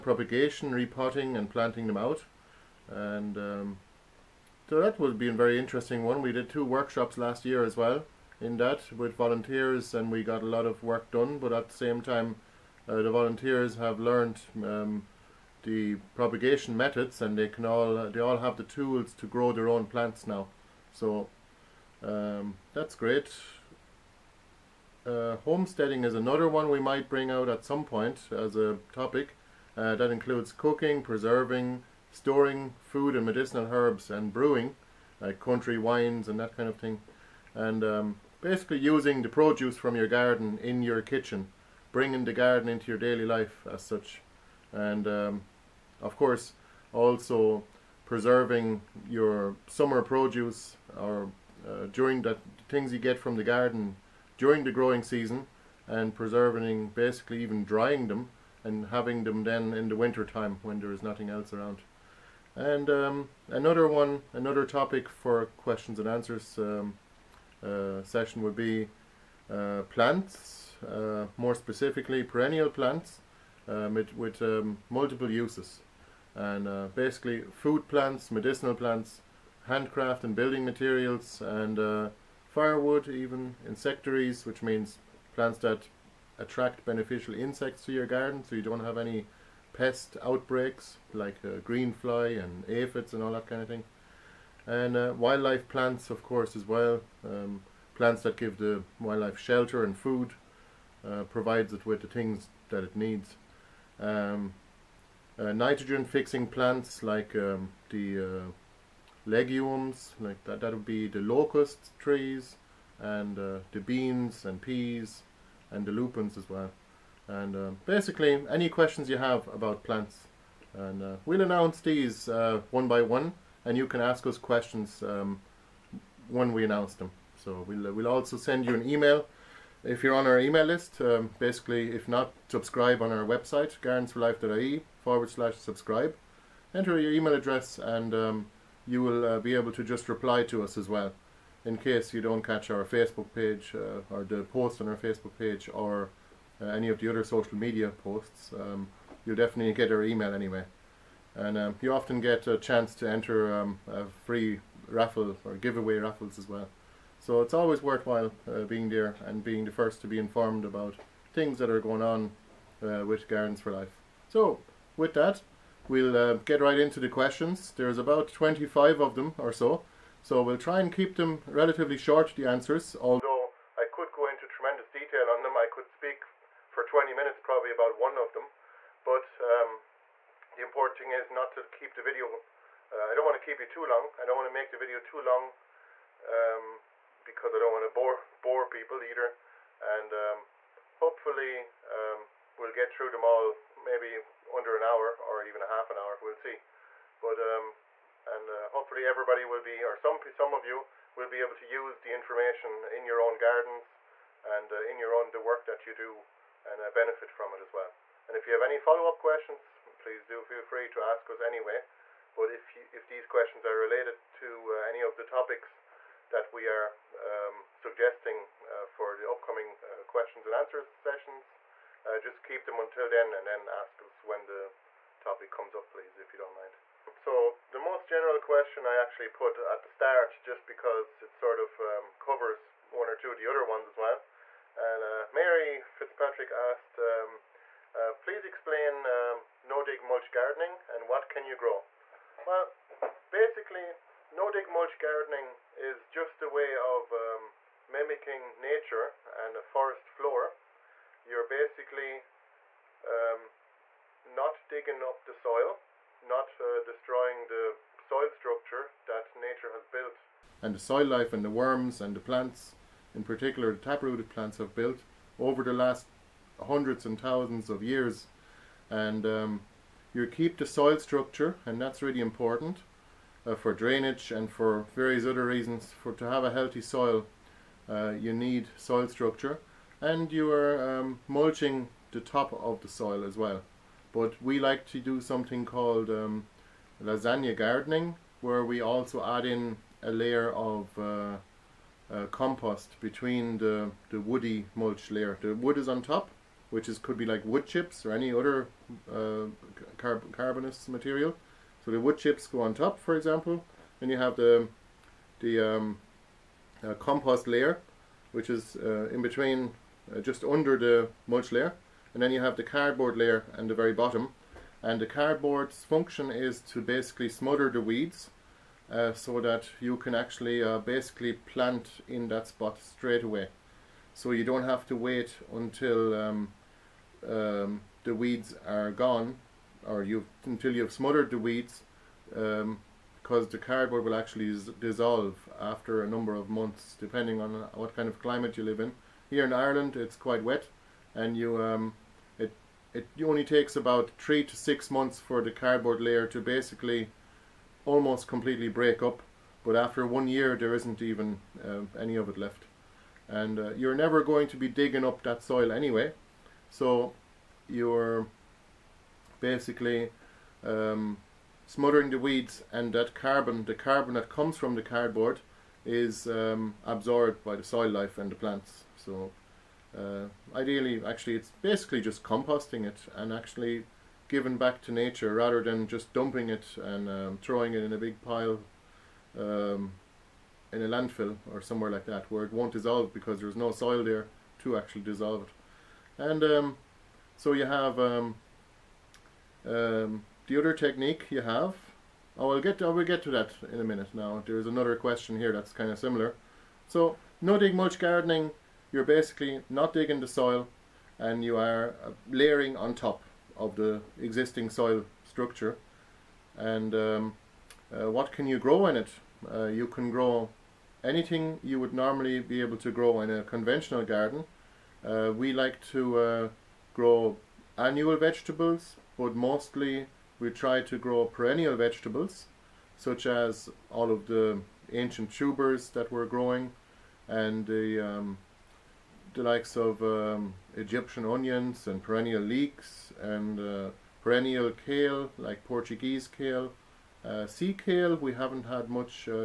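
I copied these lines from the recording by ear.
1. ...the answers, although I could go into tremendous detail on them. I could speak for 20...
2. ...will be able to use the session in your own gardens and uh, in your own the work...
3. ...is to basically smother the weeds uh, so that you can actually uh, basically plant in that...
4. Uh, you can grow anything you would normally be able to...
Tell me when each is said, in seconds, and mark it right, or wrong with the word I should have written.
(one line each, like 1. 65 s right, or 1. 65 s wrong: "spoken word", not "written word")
1. 172 s right
2. 201 s wrong: "information", not "session"
3. 316 s right
4. 409 s right.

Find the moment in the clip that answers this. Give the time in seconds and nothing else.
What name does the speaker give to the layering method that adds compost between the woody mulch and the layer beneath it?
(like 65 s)
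287 s.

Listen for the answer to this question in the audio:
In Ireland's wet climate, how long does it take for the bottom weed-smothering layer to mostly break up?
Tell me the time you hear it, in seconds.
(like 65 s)
344 s.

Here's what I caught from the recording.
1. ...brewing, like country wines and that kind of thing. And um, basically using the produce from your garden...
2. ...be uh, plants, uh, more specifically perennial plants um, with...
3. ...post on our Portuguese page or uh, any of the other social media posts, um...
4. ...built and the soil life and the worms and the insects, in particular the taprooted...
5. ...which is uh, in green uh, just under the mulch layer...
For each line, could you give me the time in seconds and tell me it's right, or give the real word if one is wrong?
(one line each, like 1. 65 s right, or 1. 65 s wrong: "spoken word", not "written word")
1. 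34 s right
2. 68 s right
3. 144 s wrong: "Facebook", not "Portuguese"
4. 259 s wrong: "plants", not "insects"
5. 308 s wrong: "between", not "green".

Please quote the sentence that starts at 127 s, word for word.
So we'll, uh, we'll also send you an email.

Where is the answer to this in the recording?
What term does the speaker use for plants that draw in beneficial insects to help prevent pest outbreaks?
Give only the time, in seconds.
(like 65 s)
83 s.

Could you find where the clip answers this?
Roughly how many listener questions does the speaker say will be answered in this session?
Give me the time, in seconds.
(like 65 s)
168 s.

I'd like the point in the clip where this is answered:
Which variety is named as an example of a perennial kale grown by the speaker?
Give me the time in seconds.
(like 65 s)
435 s.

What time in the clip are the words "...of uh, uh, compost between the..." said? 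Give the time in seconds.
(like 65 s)
290 s.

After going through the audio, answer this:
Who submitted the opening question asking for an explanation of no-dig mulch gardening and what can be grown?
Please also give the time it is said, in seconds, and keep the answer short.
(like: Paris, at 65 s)
Mary Fitzpatrick, at 235 s.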